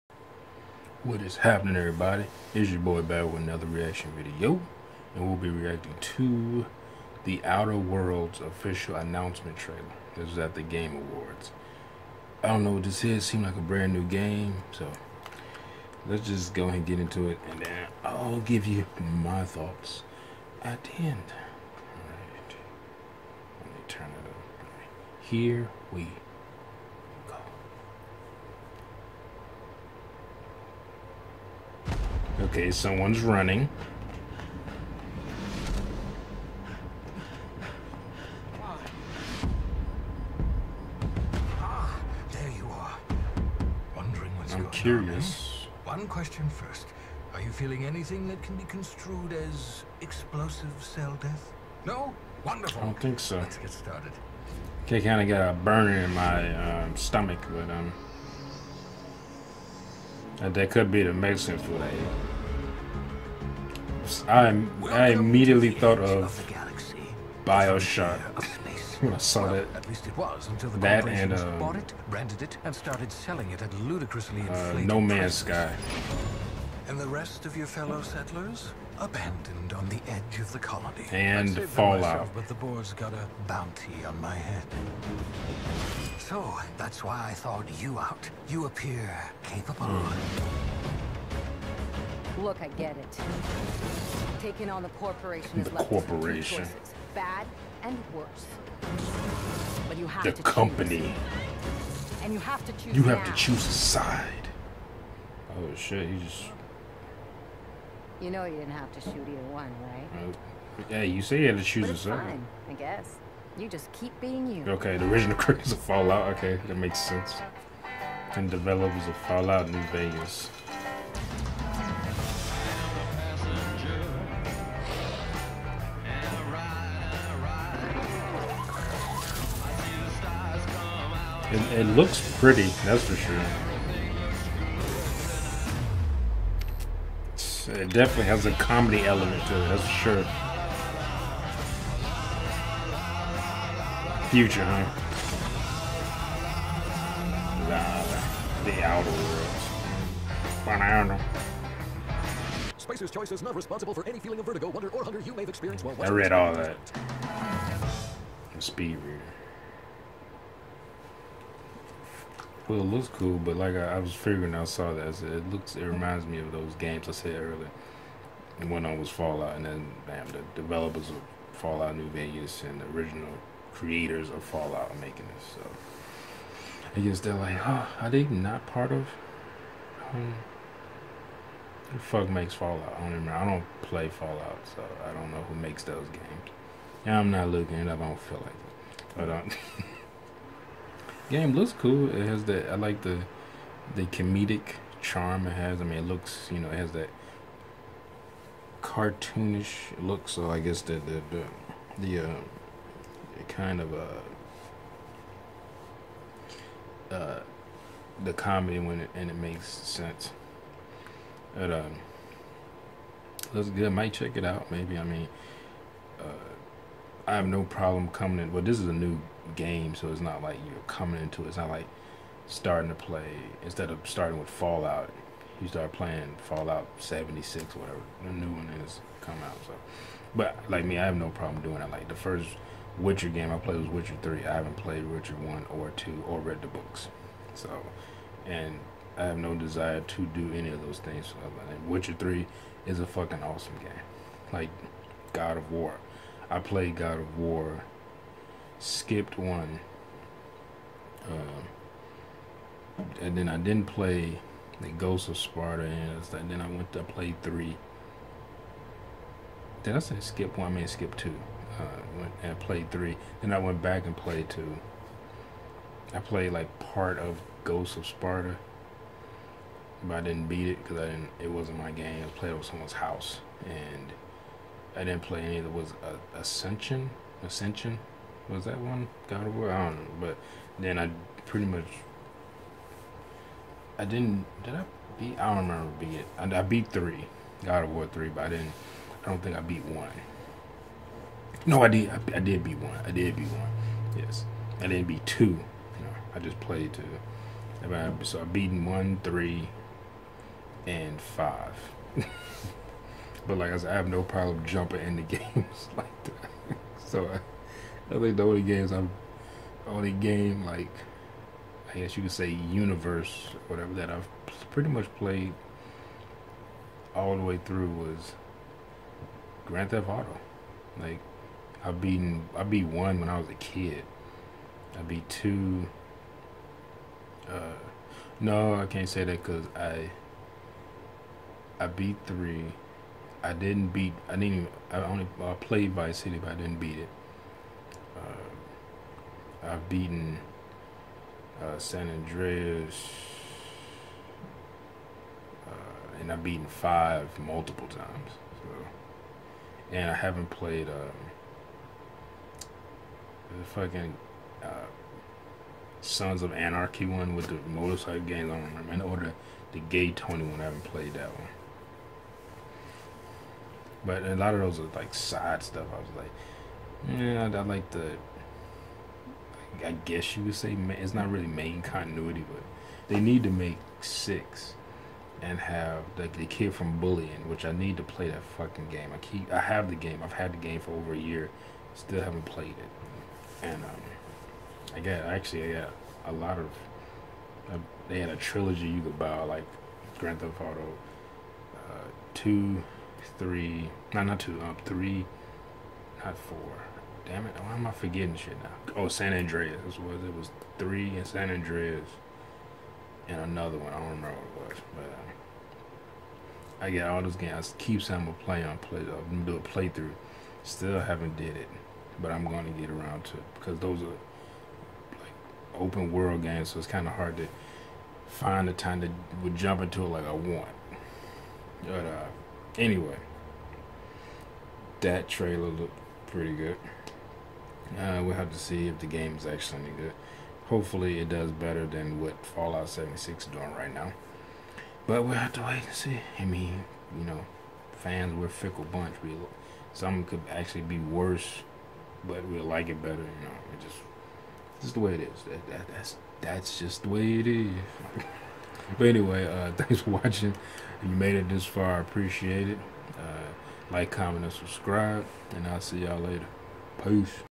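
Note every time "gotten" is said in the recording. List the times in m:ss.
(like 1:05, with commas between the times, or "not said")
not said.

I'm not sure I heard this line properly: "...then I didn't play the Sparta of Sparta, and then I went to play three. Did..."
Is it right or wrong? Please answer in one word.
wrong.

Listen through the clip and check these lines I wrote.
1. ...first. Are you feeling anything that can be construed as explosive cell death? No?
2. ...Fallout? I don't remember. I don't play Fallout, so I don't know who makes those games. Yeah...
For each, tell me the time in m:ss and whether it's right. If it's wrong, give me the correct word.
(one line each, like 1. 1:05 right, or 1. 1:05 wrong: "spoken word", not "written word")
1. 0:46 right
2. 3:02 right.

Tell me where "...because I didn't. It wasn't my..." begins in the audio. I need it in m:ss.
4:30.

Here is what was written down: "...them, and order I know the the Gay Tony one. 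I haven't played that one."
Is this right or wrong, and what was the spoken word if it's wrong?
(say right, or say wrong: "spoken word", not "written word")
right.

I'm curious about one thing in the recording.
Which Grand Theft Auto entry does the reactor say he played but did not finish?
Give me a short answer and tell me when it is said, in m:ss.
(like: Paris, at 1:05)
Vice City, at 5:35.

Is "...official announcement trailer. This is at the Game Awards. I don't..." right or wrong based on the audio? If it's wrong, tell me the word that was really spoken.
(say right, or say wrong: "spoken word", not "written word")
right.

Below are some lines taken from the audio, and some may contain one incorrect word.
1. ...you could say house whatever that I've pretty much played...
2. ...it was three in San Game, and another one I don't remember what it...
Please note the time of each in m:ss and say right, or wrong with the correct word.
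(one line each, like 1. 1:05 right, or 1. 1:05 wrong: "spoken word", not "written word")
1. 5:12 wrong: "universe", not "house"
2. 6:40 wrong: "Andreas", not "Game".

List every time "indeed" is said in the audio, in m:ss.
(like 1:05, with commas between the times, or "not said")
not said.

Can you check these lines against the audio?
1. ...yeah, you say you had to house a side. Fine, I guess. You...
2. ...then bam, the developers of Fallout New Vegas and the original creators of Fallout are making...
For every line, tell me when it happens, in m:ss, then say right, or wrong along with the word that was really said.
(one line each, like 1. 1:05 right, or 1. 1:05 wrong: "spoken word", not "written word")
1. 1:50 wrong: "choose", not "house"
2. 2:49 right.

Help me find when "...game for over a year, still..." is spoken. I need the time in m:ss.
6:20.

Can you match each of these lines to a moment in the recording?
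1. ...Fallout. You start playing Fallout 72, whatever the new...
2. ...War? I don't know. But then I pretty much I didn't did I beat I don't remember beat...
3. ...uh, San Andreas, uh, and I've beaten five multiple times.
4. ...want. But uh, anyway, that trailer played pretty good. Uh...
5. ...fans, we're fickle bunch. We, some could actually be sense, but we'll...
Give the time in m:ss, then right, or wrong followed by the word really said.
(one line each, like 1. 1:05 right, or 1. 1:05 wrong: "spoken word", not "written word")
1. 3:44 wrong: "76", not "72"
2. 4:39 right
3. 5:41 right
4. 7:00 wrong: "looked", not "played"
5. 7:17 wrong: "worse", not "sense".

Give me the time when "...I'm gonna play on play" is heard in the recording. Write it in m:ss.
6:48.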